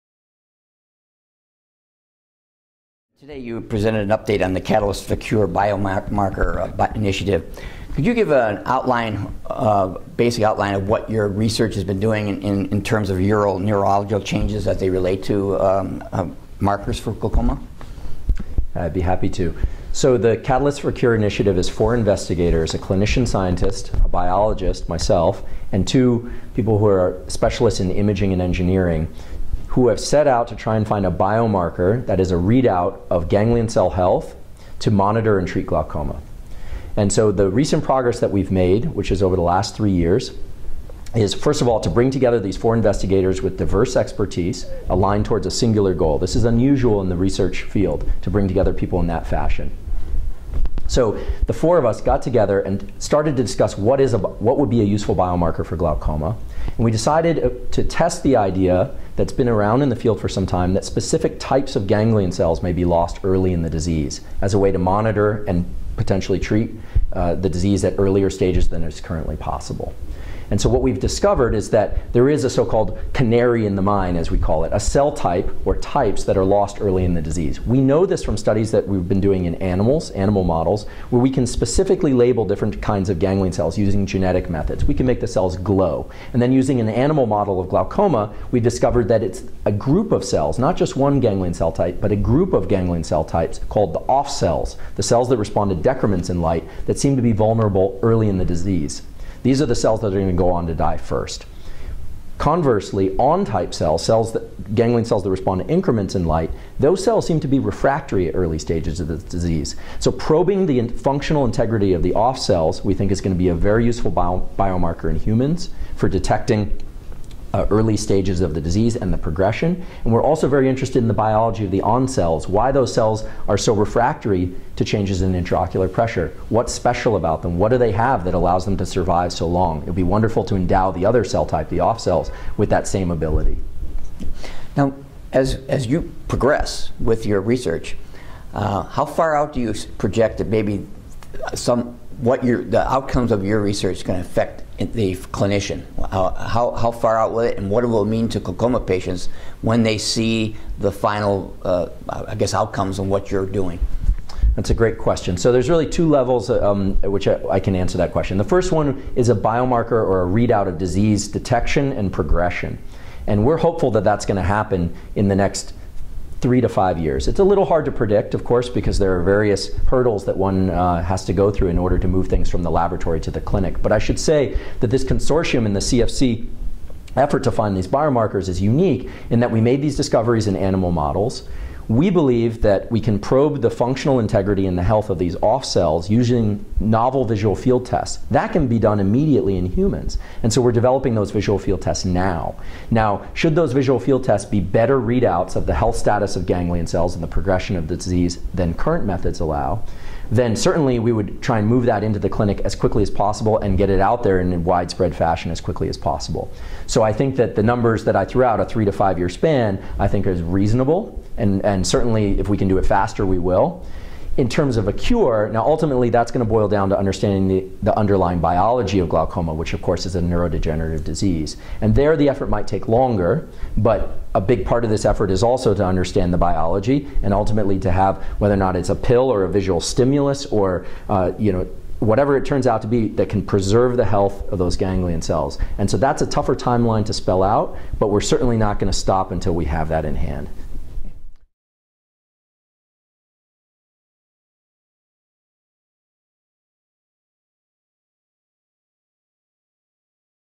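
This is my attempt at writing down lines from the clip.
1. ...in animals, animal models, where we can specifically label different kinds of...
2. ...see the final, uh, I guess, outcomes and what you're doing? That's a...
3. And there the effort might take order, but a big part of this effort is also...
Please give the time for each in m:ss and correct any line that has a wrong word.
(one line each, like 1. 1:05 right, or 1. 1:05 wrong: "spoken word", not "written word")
1. 1:19 right
2. 2:29 right
3. 3:41 wrong: "longer", not "order".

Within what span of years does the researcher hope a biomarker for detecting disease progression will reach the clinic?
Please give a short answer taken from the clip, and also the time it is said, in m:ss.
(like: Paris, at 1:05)
3 to 5 years, at 2:46.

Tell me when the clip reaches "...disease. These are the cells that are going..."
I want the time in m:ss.
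1:38.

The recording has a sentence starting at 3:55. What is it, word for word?
And so that's a tougher timeline to spell out, but we're certainly not going to stop until we have that in hand.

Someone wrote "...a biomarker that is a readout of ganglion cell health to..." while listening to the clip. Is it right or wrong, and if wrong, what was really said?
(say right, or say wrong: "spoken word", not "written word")
right.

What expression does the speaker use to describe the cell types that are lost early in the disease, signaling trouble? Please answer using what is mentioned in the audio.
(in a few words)
canary in the mine.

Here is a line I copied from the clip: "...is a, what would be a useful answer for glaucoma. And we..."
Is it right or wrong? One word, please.
wrong.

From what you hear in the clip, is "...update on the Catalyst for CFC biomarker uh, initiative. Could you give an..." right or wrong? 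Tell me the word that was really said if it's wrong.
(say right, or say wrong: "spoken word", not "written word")
wrong: "Cure", not "CFC".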